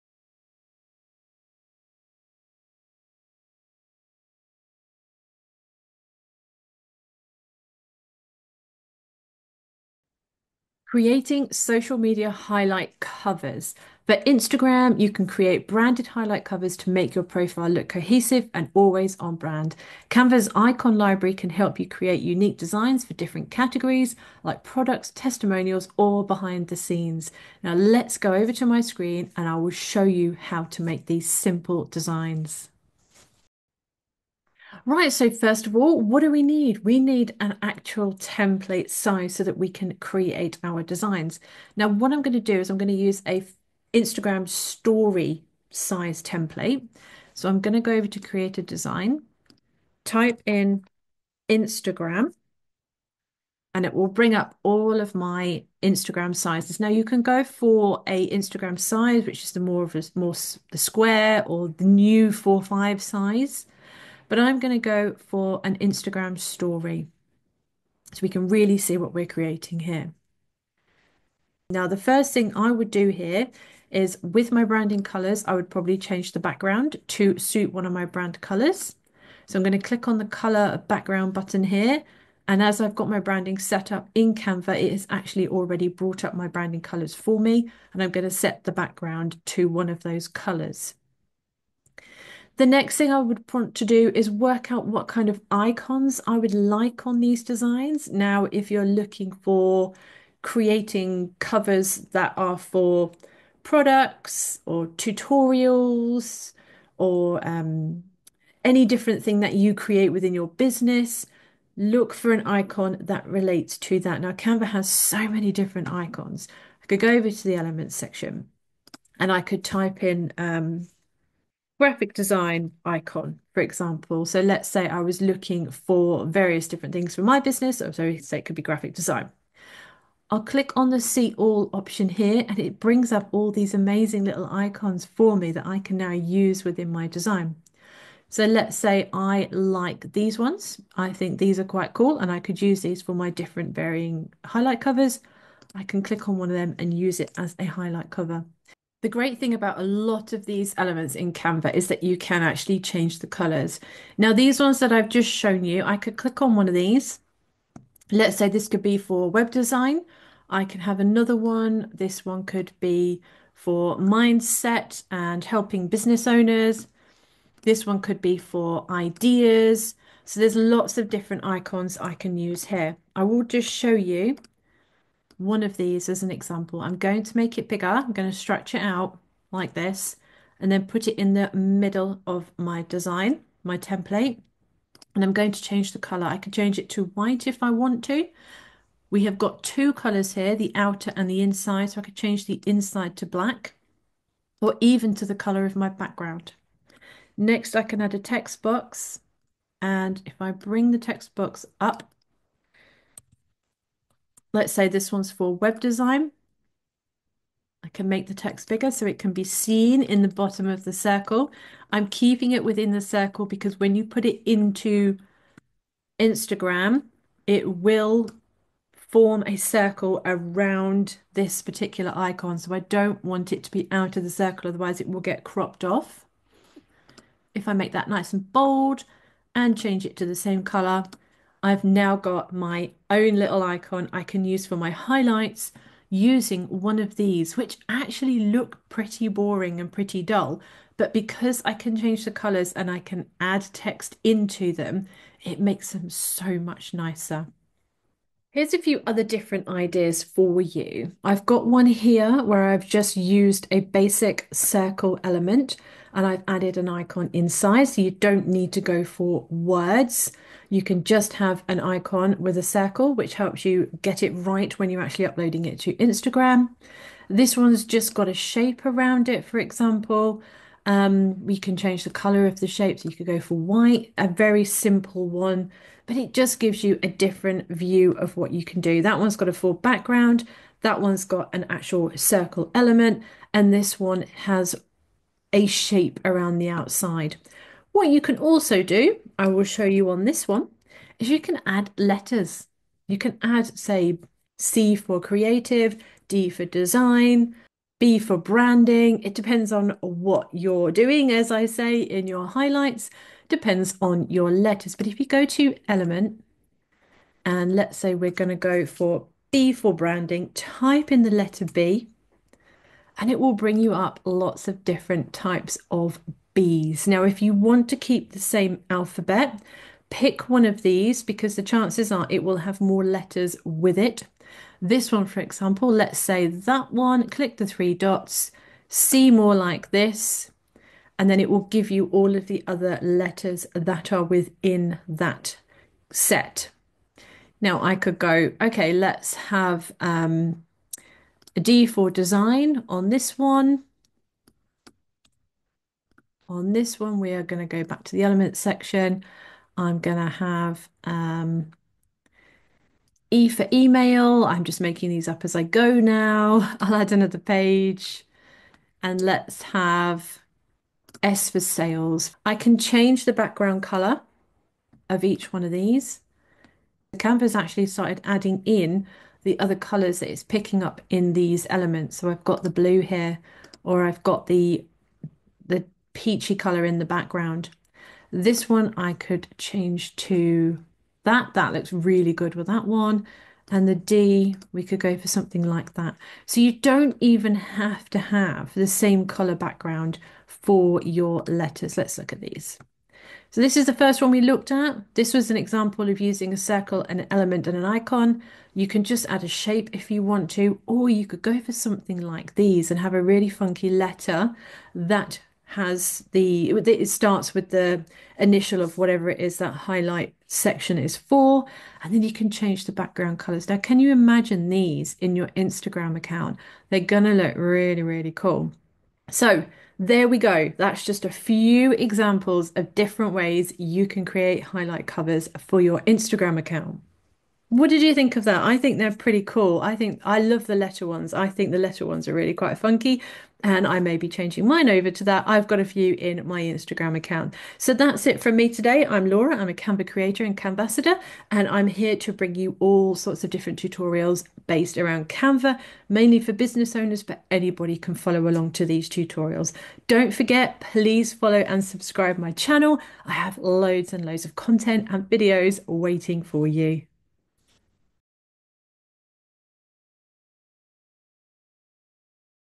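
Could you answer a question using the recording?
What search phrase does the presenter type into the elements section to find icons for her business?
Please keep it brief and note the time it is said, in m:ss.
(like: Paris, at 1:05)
graphic design icon, at 2:01.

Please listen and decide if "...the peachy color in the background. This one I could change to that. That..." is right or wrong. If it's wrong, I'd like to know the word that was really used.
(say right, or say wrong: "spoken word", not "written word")
right.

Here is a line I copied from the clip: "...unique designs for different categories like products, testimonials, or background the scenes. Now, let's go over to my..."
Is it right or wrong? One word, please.
wrong.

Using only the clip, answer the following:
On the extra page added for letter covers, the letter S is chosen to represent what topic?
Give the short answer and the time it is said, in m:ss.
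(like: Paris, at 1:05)
sales, at 6:01.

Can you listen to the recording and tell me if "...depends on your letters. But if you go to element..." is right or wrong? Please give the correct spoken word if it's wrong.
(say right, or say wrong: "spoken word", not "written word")
right.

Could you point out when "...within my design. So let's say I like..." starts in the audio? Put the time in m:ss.
2:16.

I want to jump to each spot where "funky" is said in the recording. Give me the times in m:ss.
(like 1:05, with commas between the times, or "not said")
6:43, 7:12.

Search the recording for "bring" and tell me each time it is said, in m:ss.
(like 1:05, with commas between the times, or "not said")
0:54, 2:12, 3:20, 5:13, 7:22.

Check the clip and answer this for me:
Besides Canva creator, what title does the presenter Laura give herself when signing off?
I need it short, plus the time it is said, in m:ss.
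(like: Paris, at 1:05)
Canvassador, at 7:20.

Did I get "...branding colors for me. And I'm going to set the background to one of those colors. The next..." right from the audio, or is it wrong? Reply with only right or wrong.
right.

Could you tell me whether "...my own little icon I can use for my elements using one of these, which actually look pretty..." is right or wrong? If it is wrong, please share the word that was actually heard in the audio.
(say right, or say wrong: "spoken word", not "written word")
wrong: "highlights", not "elements".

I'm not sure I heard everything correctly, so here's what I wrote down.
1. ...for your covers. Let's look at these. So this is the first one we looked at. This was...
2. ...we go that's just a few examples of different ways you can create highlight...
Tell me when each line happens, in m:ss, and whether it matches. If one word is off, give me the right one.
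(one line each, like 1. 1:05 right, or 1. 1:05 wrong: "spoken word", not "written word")
1. 6:30 wrong: "letters", not "covers"
2. 7:00 right.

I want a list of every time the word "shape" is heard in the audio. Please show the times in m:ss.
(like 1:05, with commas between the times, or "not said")
4:28, 4:32, 4:45, 6:39.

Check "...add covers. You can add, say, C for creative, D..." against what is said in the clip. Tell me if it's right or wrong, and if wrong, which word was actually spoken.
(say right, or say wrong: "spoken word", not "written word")
wrong: "letters", not "covers".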